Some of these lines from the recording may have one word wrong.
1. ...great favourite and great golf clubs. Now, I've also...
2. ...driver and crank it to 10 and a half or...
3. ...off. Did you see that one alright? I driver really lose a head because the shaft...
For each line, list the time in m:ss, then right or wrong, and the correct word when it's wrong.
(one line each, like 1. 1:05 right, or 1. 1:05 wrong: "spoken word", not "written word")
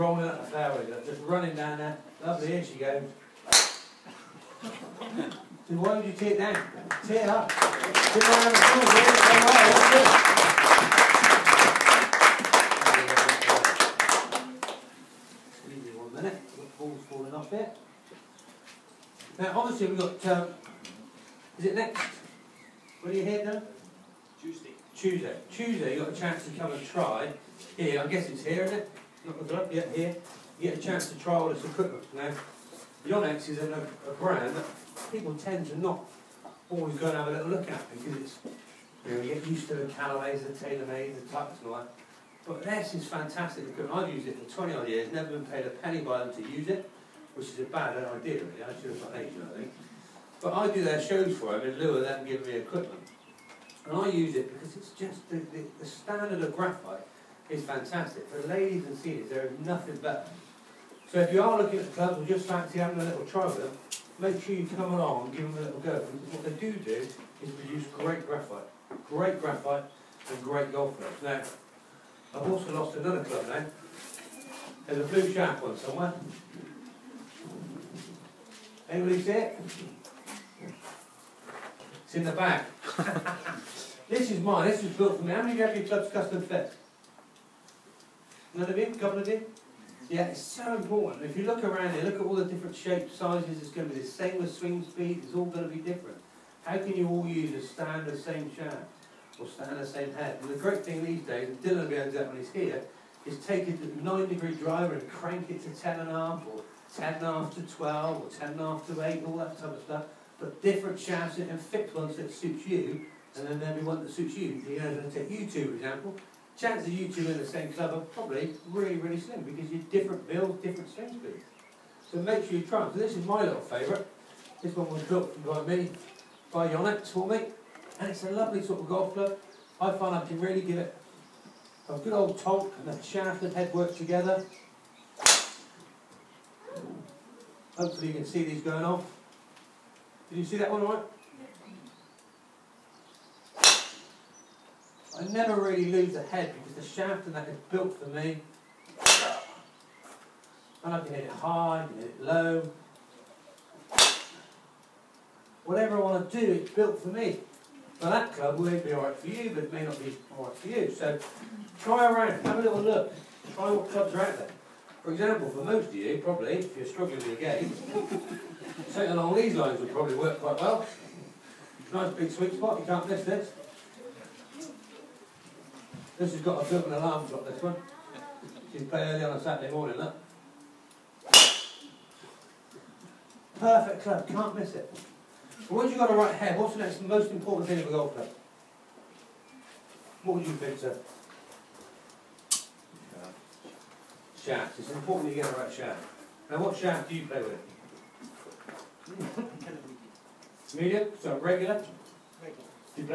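1. 1:09 wrong: "graphite", not "favourite"
2. 1:44 right
3. 2:18 wrong: "never", not "driver".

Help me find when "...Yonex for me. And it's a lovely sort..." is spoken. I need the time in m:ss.
2:06.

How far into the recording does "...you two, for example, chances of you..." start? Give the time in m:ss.
1:55.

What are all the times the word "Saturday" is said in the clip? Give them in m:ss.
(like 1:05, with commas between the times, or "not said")
2:59.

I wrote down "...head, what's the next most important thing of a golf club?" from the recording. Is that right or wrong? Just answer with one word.
right.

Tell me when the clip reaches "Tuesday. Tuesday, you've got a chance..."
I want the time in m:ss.
0:24.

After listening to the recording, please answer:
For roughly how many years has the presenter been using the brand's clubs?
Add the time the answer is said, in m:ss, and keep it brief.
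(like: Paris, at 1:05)
20 odd years, at 0:44.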